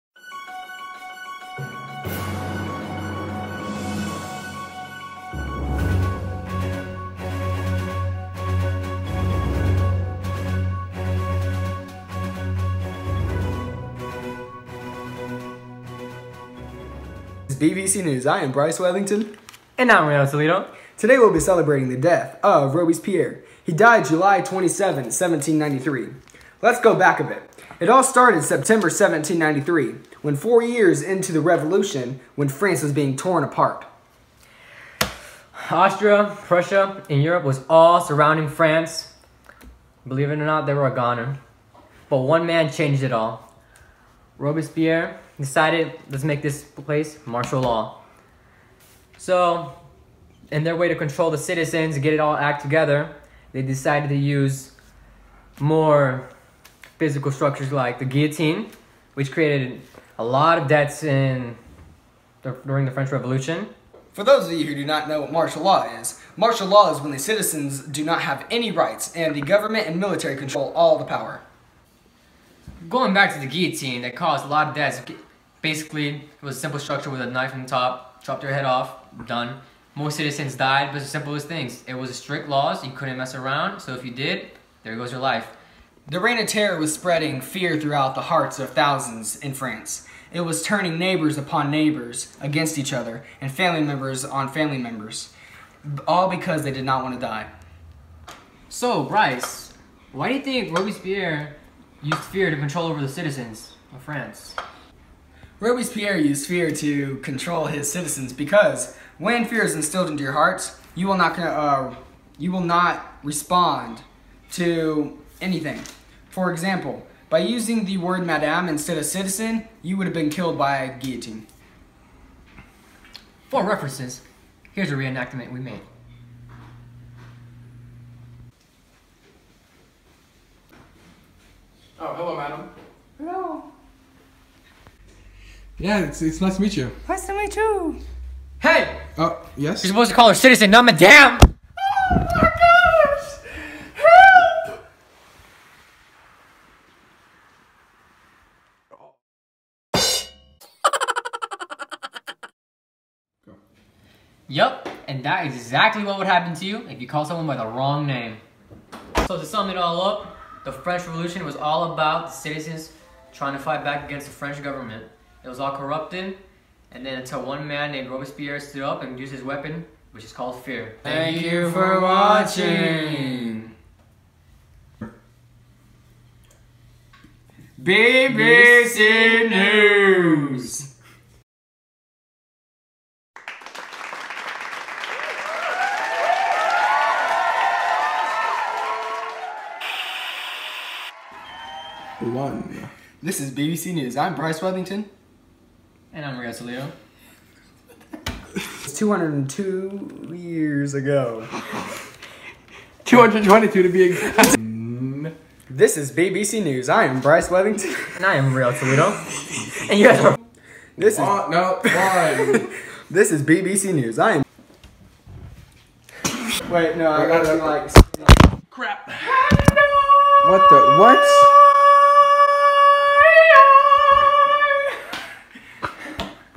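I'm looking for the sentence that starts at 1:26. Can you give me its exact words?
The Reign of Terror was spreading fear throughout the hearts of thousands in France.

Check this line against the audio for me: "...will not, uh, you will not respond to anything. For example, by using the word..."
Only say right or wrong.
right.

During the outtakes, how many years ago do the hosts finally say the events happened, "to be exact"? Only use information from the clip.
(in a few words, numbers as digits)
222.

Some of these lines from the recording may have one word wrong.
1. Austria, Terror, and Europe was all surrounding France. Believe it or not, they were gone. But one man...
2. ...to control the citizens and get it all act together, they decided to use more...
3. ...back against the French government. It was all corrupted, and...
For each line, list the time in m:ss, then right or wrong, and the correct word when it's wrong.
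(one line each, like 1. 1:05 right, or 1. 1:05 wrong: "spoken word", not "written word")
1. 0:35 wrong: "Prussia", not "Terror"
2. 0:50 right
3. 2:43 right.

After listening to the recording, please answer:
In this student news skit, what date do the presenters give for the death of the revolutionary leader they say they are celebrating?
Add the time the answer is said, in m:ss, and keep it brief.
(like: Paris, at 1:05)
July 27, 1793, at 0:24.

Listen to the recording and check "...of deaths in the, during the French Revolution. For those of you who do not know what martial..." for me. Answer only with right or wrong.
right.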